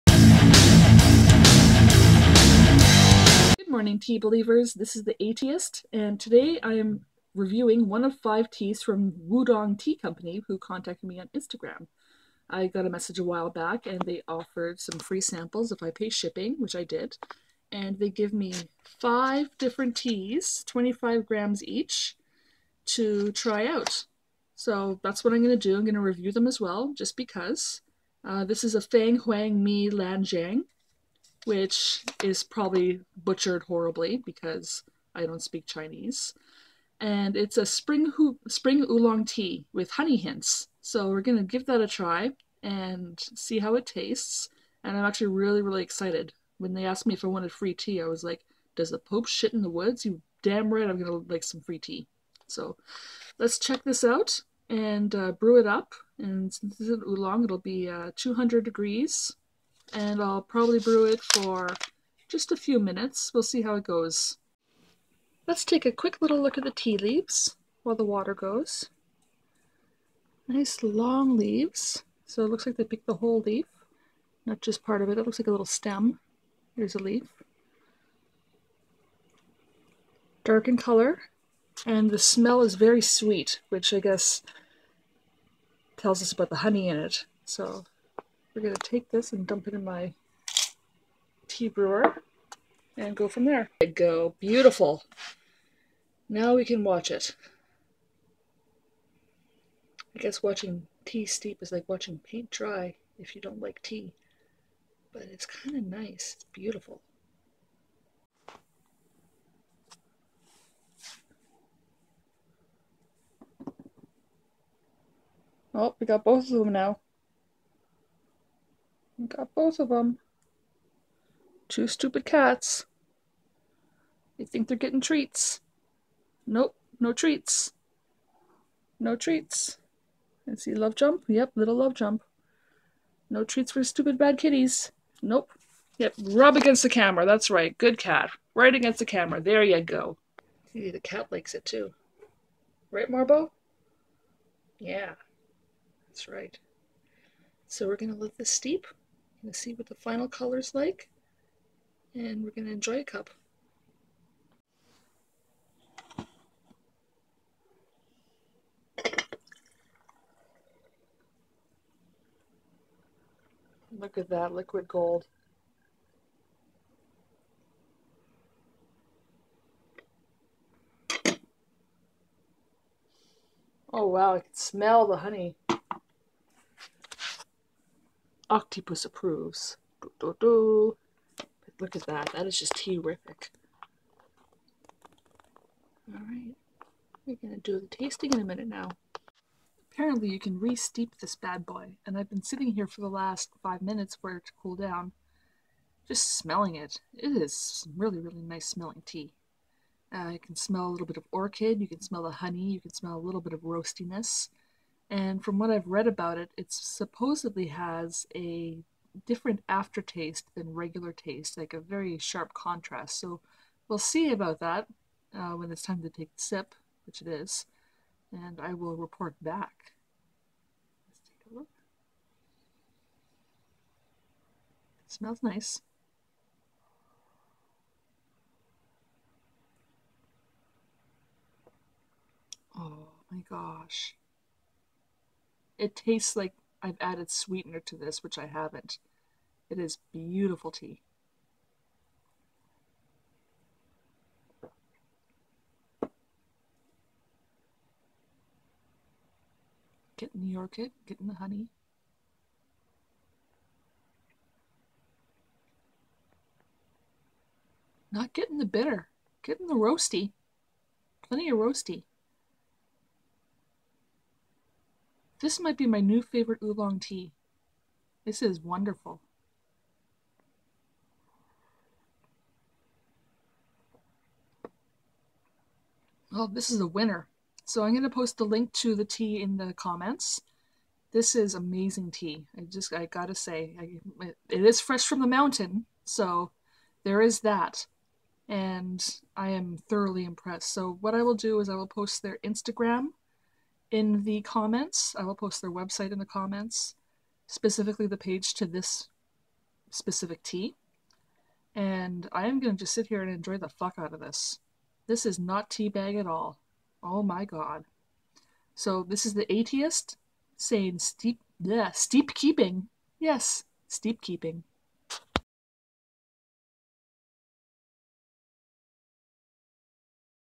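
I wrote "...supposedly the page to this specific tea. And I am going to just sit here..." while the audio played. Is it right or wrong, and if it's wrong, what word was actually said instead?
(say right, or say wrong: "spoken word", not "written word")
wrong: "specifically", not "supposedly".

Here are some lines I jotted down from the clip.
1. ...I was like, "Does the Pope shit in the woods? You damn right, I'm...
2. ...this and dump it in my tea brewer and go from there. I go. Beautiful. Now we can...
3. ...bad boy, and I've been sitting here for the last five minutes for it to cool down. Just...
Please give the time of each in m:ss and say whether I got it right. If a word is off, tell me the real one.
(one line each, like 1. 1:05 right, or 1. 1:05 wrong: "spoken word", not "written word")
1. 0:48 right
2. 1:29 right
3. 3:11 right.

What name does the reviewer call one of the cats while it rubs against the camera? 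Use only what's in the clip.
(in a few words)
Marbo.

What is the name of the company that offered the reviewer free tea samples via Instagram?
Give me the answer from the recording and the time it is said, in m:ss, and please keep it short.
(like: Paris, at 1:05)
Wudong Tea Company, at 0:09.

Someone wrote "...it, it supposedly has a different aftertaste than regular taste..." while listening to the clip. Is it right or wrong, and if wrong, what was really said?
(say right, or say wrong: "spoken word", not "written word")
right.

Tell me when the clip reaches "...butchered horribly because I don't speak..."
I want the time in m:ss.
0:33.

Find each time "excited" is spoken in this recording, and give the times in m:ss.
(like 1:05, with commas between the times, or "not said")
0:45.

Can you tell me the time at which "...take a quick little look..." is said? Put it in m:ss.
1:05.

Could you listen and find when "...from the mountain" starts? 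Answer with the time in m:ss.
4:45.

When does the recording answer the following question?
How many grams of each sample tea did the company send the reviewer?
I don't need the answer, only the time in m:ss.
0:20.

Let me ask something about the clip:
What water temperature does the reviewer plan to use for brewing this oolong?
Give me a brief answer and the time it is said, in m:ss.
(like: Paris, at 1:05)
200 degrees, at 0:58.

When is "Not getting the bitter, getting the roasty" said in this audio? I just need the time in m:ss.
4:18.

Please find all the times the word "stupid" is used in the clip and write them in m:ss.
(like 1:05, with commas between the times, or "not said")
2:01, 2:13.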